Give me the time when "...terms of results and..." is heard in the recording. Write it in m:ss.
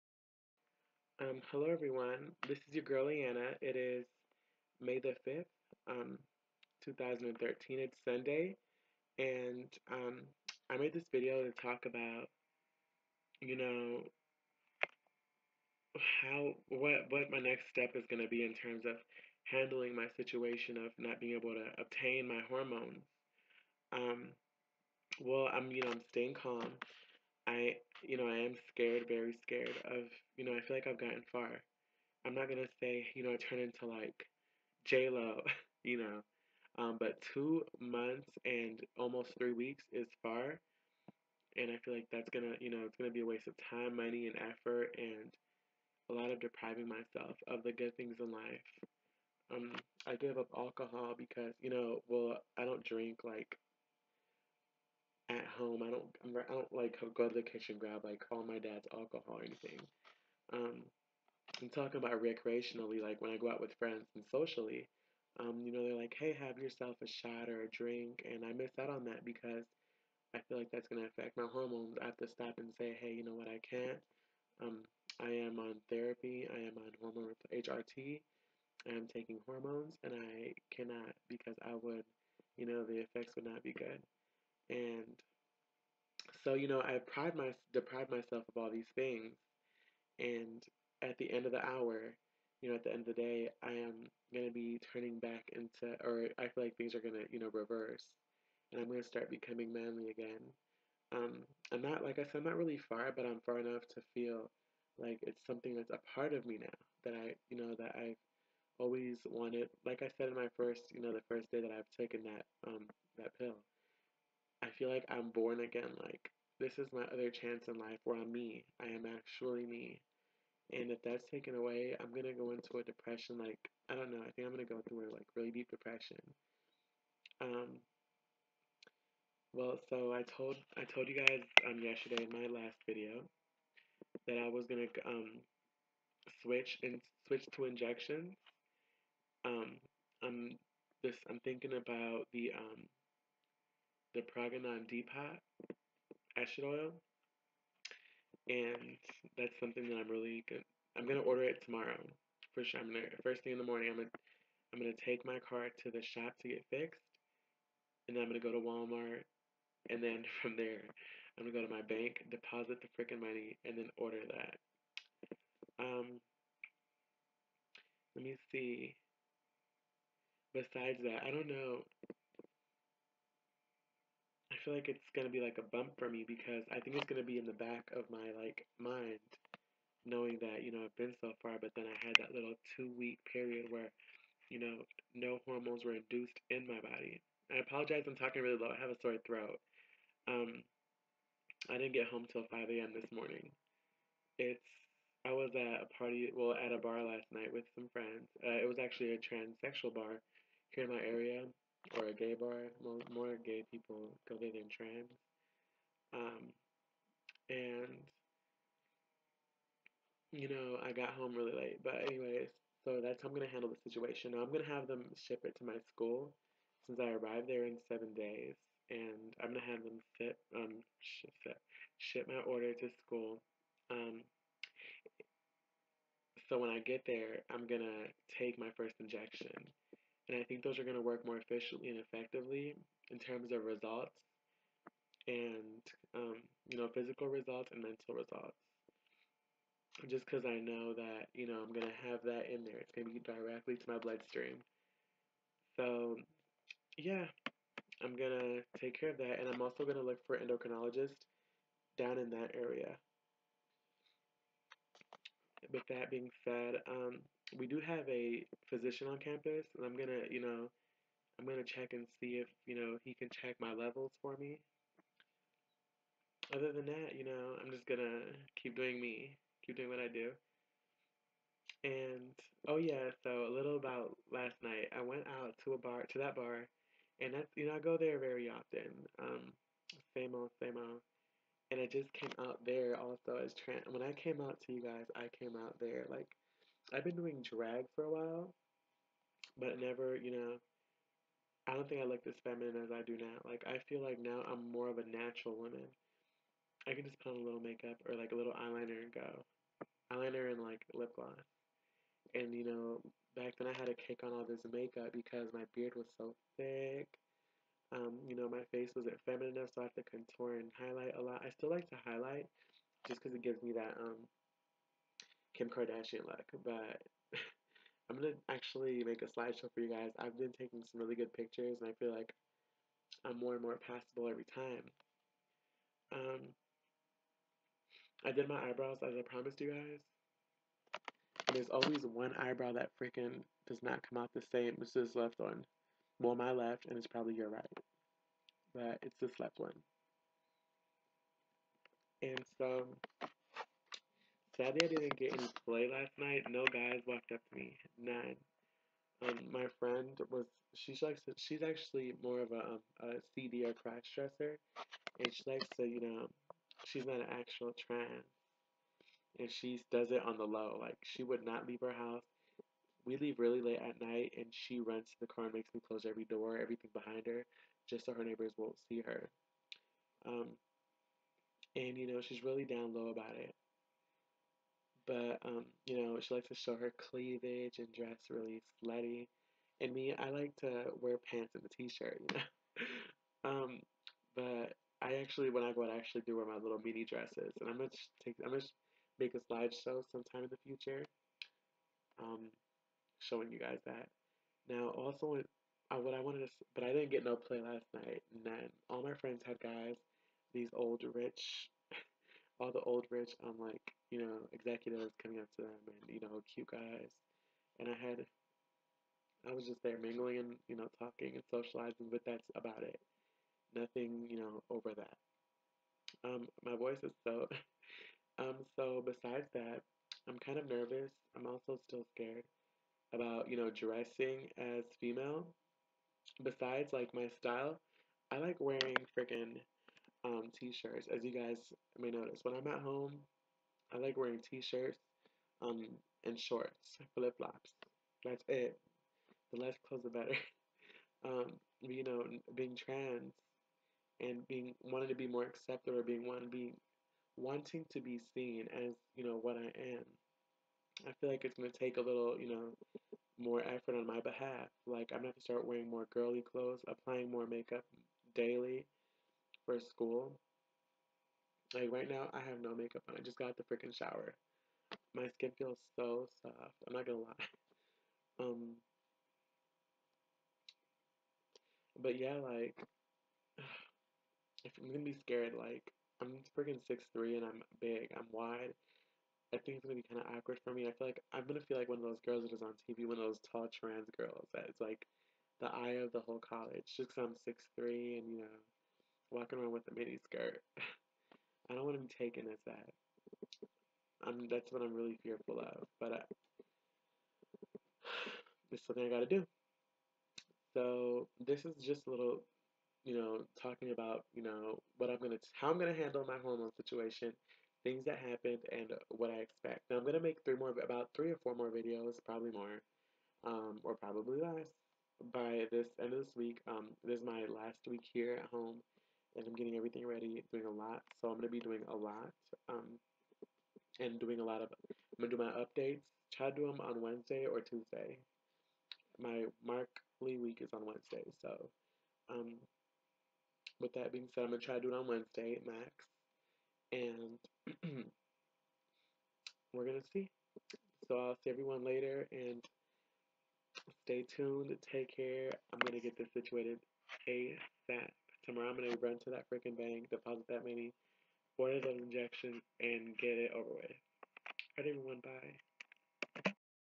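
3:53.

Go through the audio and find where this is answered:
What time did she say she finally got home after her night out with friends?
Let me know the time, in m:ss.
3:12.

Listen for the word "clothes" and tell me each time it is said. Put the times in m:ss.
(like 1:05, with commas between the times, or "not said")
7:19, 7:36.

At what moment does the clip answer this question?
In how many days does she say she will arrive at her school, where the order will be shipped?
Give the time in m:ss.
3:37.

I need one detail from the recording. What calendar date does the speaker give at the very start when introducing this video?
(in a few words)
May 5th, 2013.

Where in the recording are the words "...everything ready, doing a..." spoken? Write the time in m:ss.
8:39.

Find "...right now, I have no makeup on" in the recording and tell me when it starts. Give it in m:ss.
7:41.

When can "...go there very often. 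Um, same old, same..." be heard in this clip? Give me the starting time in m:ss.
4:37.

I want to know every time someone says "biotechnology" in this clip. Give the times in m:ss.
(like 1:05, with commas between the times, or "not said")
not said.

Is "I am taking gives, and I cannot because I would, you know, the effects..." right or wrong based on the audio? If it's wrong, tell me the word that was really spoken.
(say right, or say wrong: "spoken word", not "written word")
wrong: "hormones", not "gives".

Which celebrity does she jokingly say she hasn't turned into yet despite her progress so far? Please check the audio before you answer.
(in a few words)
J Lo.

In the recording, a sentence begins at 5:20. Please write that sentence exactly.
I've been taking some really good pictures, and I feel like I'm more and more passable every time.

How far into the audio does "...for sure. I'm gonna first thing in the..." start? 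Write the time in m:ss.
2:32.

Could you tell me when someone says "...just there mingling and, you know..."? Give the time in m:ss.
6:49.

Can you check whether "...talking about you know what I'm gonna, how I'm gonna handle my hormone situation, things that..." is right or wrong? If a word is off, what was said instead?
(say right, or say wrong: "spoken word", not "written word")
right.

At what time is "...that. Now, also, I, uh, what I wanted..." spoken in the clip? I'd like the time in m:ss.
6:33.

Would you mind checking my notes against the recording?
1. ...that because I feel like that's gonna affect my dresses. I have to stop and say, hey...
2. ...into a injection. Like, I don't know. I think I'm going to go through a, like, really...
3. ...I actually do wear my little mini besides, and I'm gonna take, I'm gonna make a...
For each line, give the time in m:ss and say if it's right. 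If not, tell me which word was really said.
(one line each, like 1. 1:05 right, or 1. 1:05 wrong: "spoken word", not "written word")
1. 1:09 wrong: "hormones", not "dresses"
2. 2:02 wrong: "depression", not "injection"
3. 6:25 wrong: "dresses", not "besides".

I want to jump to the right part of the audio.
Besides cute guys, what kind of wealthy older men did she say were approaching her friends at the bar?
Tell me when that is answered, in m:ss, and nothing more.
6:44.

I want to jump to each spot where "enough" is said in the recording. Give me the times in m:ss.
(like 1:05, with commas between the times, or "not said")
1:43, 5:09.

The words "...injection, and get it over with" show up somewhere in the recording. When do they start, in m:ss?
9:11.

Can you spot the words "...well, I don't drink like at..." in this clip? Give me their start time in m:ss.
0:52.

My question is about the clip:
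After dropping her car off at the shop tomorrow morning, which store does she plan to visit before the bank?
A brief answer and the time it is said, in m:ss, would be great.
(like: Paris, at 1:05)
Walmart, at 2:38.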